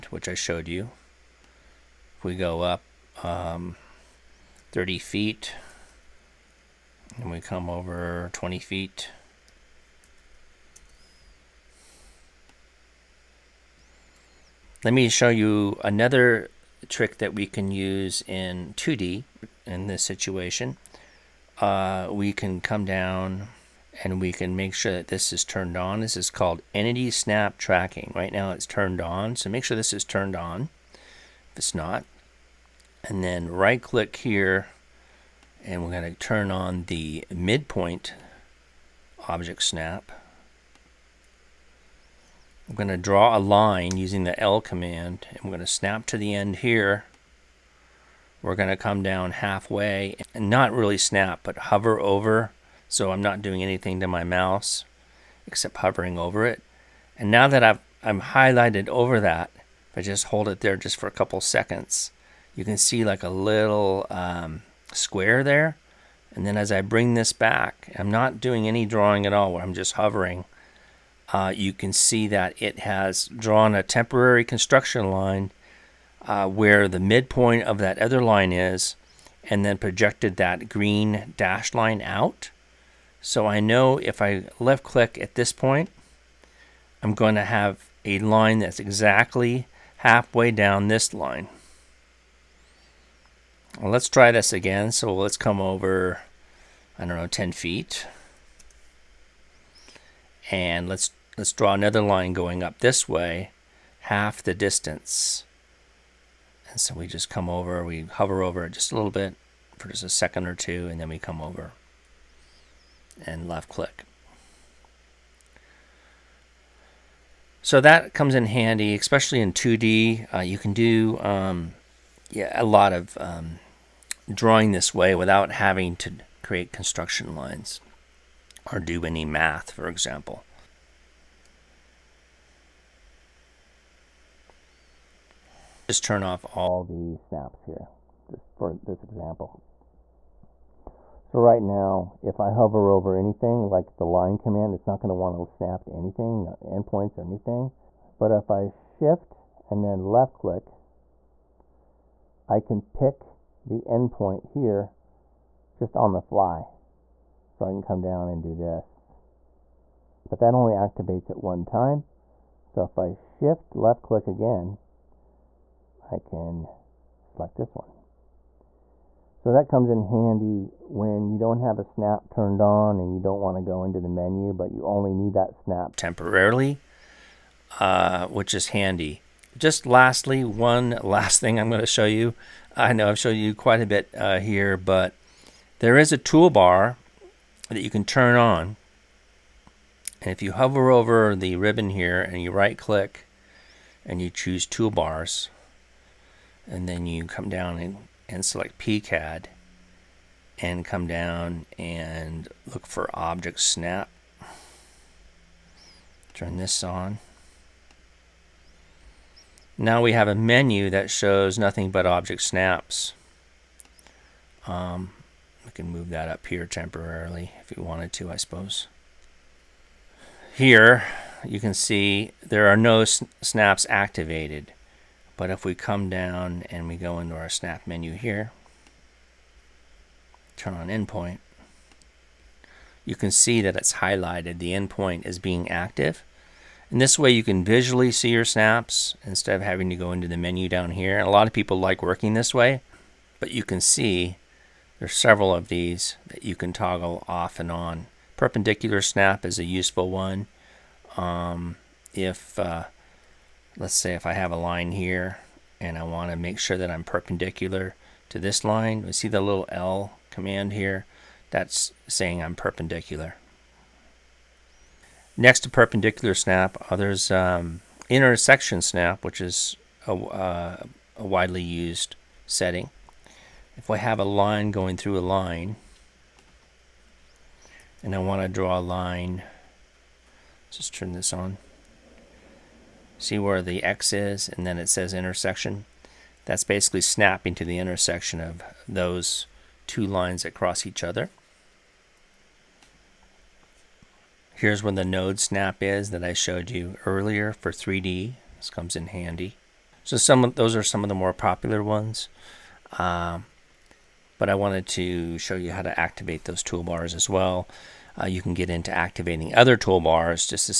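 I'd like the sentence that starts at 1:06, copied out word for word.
And then as I bring this back, I'm not doing any drawing at all, I'm just hovering.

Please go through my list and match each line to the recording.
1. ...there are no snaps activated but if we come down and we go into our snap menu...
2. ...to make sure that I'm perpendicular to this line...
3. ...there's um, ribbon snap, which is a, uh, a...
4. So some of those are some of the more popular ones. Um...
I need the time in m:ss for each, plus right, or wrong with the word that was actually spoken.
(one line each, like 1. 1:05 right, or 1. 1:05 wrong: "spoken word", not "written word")
1. 3:42 right
2. 4:16 right
3. 4:26 wrong: "intersection", not "ribbon"
4. 5:00 right.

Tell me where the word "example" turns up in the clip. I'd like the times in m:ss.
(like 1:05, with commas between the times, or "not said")
2:09, 2:19.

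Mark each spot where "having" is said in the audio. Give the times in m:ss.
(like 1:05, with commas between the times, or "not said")
2:05, 3:59.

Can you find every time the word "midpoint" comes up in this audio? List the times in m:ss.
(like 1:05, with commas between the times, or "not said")
0:37, 1:17.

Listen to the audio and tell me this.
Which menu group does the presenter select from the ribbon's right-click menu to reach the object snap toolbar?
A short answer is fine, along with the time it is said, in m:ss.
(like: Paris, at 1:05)
PCAD, at 3:18.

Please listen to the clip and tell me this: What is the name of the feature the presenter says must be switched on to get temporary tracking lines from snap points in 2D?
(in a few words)
Entity Snap Tracking.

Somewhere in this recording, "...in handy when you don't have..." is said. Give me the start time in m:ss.
2:49.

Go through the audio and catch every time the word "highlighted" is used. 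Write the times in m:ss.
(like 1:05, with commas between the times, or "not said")
0:58, 3:53.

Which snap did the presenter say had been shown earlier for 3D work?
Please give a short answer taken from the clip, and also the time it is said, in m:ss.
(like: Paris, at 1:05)
Node snap, at 4:55.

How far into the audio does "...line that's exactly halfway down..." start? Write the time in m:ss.
1:28.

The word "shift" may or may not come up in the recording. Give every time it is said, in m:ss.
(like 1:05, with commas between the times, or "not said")
2:28, 2:43.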